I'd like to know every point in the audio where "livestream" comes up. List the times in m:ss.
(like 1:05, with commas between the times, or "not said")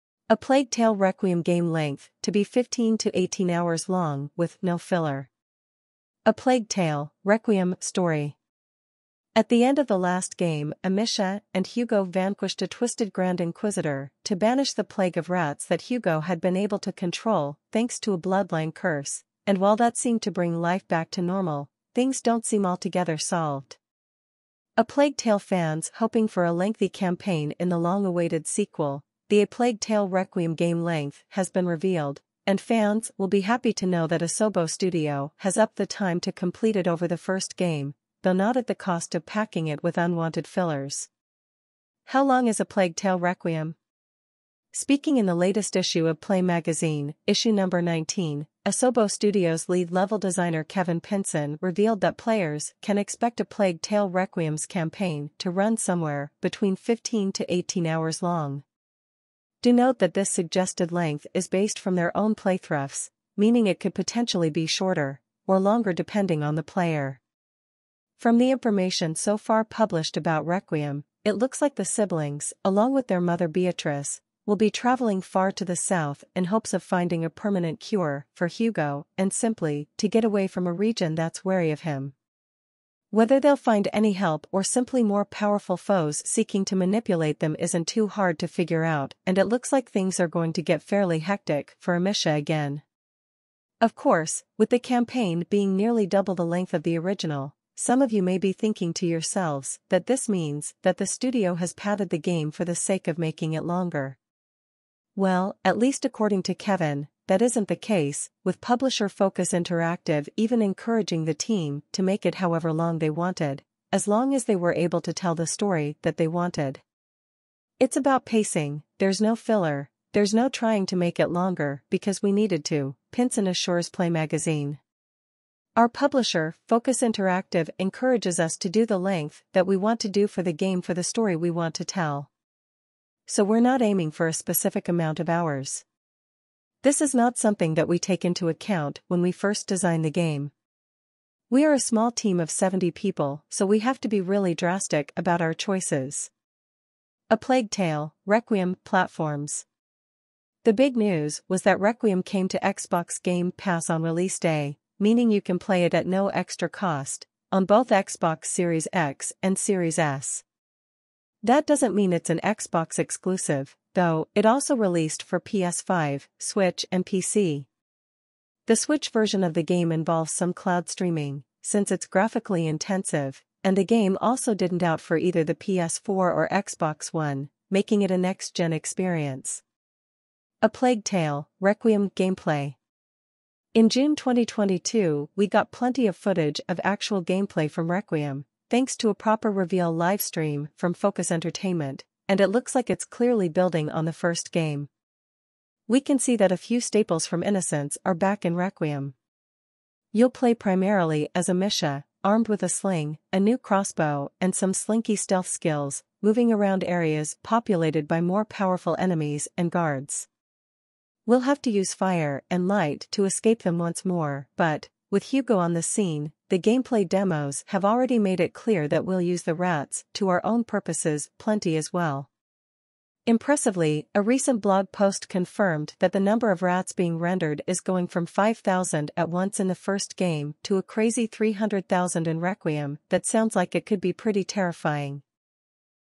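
3:09.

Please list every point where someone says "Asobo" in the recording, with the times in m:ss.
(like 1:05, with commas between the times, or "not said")
0:34, 0:48.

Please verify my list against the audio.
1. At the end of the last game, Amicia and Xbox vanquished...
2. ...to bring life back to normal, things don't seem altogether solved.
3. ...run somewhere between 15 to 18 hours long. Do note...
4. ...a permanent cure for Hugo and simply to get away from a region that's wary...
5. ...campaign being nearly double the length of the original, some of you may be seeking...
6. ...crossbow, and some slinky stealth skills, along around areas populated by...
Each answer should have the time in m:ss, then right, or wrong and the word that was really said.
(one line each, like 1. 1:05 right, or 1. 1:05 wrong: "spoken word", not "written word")
1. 0:09 wrong: "Hugo", not "Xbox"
2. 0:20 right
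3. 0:55 right
4. 1:17 right
5. 1:34 wrong: "thinking", not "seeking"
6. 3:23 wrong: "moving", not "along".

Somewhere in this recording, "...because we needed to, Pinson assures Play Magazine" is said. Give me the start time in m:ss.
2:01.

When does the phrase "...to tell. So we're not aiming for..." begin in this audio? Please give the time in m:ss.
2:11.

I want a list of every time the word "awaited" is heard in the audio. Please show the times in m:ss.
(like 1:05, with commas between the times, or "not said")
0:27.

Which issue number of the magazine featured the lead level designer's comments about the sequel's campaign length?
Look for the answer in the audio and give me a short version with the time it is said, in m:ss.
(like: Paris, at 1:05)
19, at 0:47.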